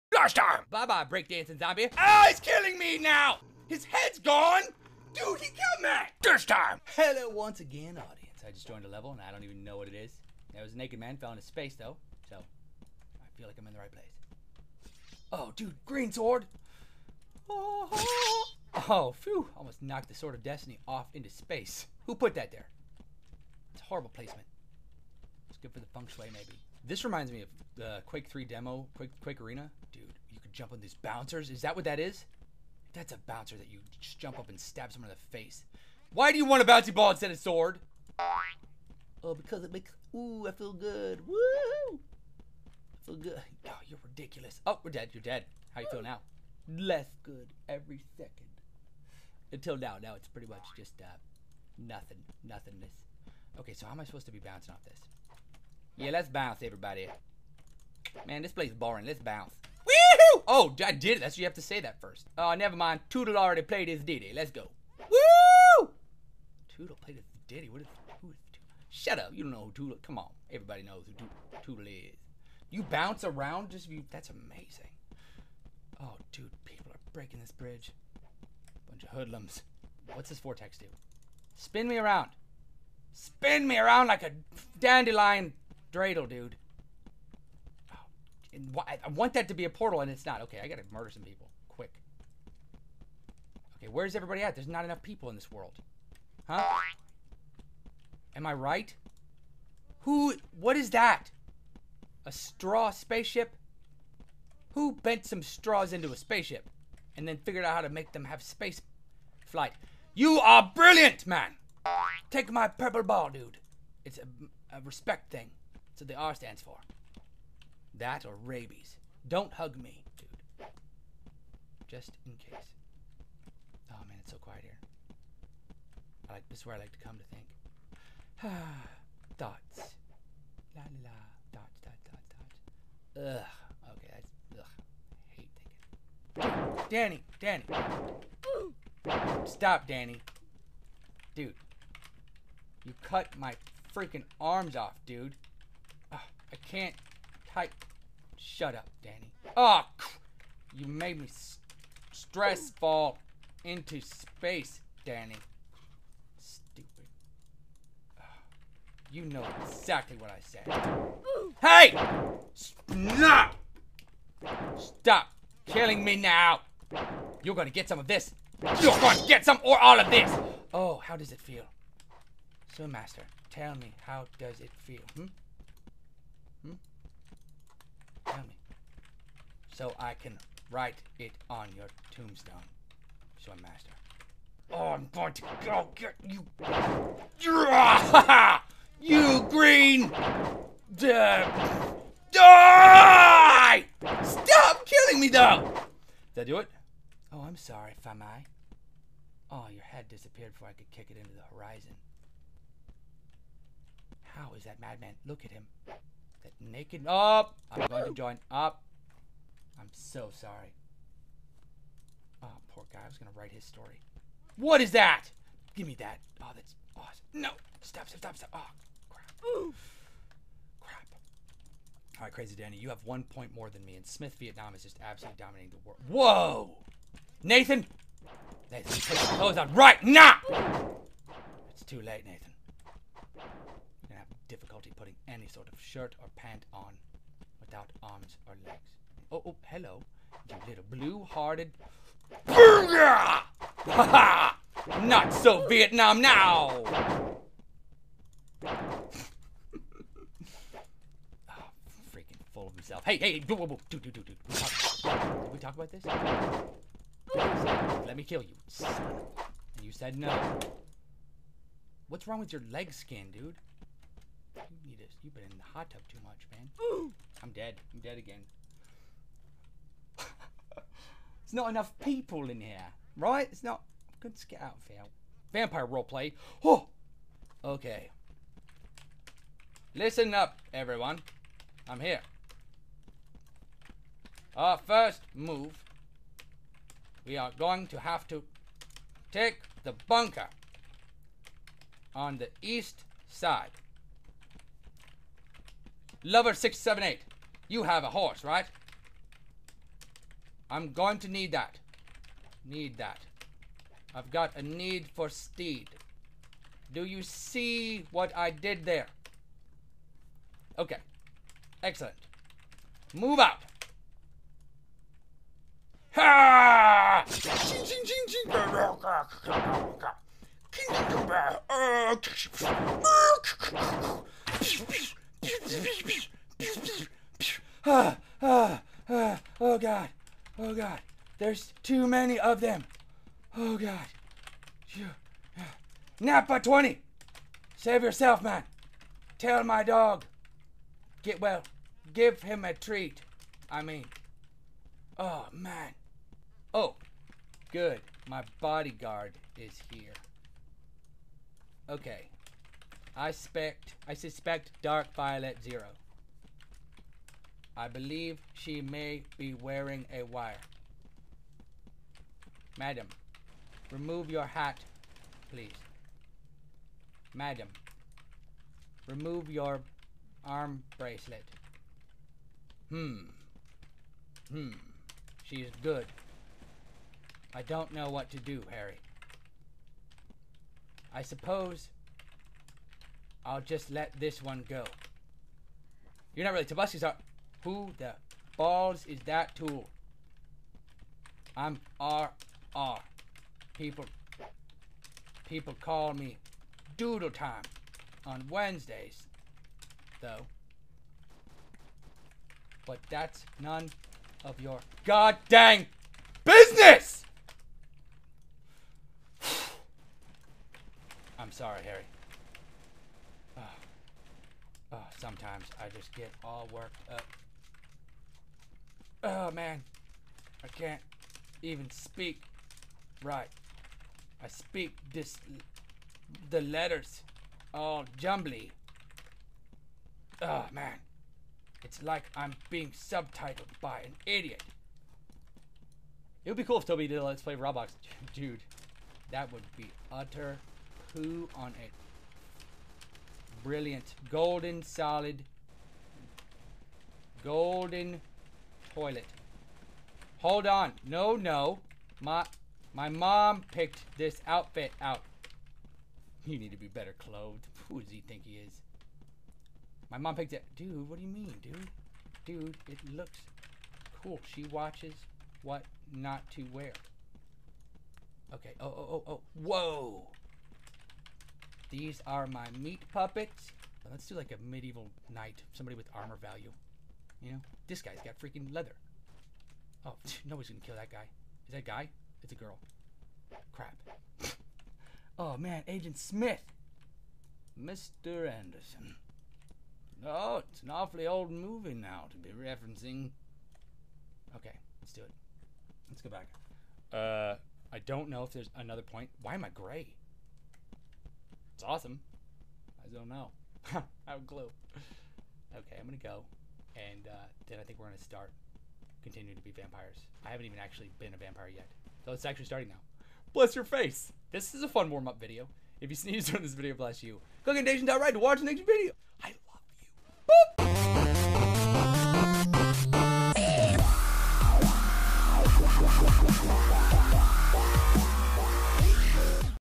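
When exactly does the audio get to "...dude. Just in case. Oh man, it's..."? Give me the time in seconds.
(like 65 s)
120 s.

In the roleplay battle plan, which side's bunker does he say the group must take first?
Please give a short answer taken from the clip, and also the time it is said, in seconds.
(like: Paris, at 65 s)
East side, at 292 s.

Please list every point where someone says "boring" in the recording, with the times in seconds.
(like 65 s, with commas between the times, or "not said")
58 s.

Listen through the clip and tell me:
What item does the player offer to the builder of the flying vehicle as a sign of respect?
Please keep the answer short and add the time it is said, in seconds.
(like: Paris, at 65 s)
Purple ball, at 112 s.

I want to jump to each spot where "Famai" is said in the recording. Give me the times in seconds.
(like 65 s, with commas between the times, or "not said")
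198 s.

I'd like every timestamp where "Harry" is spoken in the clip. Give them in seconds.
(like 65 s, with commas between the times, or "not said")
378 s, 411 s.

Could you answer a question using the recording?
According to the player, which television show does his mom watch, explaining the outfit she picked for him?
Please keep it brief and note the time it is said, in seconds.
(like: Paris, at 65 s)
What Not to Wear, at 465 s.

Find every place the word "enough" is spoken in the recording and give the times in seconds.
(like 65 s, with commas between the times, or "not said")
94 s, 271 s.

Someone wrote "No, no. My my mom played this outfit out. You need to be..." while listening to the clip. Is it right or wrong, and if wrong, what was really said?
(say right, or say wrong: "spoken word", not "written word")
wrong: "picked", not "played".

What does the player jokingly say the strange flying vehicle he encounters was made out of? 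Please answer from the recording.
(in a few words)
Straws.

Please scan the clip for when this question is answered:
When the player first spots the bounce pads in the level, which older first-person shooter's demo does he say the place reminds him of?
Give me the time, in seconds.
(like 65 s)
28 s.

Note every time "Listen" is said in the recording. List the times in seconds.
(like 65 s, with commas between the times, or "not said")
279 s.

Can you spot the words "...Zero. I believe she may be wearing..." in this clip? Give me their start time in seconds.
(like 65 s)
355 s.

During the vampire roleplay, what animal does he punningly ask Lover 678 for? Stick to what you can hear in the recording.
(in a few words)
Horse.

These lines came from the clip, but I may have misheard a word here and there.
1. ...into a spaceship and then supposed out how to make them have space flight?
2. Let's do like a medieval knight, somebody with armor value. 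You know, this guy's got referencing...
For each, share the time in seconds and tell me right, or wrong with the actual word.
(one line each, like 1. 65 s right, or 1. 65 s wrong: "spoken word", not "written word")
1. 105 s wrong: "figured", not "supposed"
2. 474 s wrong: "freaking", not "referencing".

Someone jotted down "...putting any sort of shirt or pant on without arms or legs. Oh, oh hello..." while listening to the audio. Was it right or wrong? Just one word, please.
right.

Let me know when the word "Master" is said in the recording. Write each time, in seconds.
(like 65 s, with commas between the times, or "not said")
172 s, 183 s.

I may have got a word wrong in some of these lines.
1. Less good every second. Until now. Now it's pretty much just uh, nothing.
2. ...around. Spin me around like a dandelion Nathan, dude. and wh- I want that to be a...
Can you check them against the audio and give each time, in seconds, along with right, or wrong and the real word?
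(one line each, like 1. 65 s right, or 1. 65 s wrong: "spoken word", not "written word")
1. 46 s right
2. 81 s wrong: "Dreidel", not "Nathan".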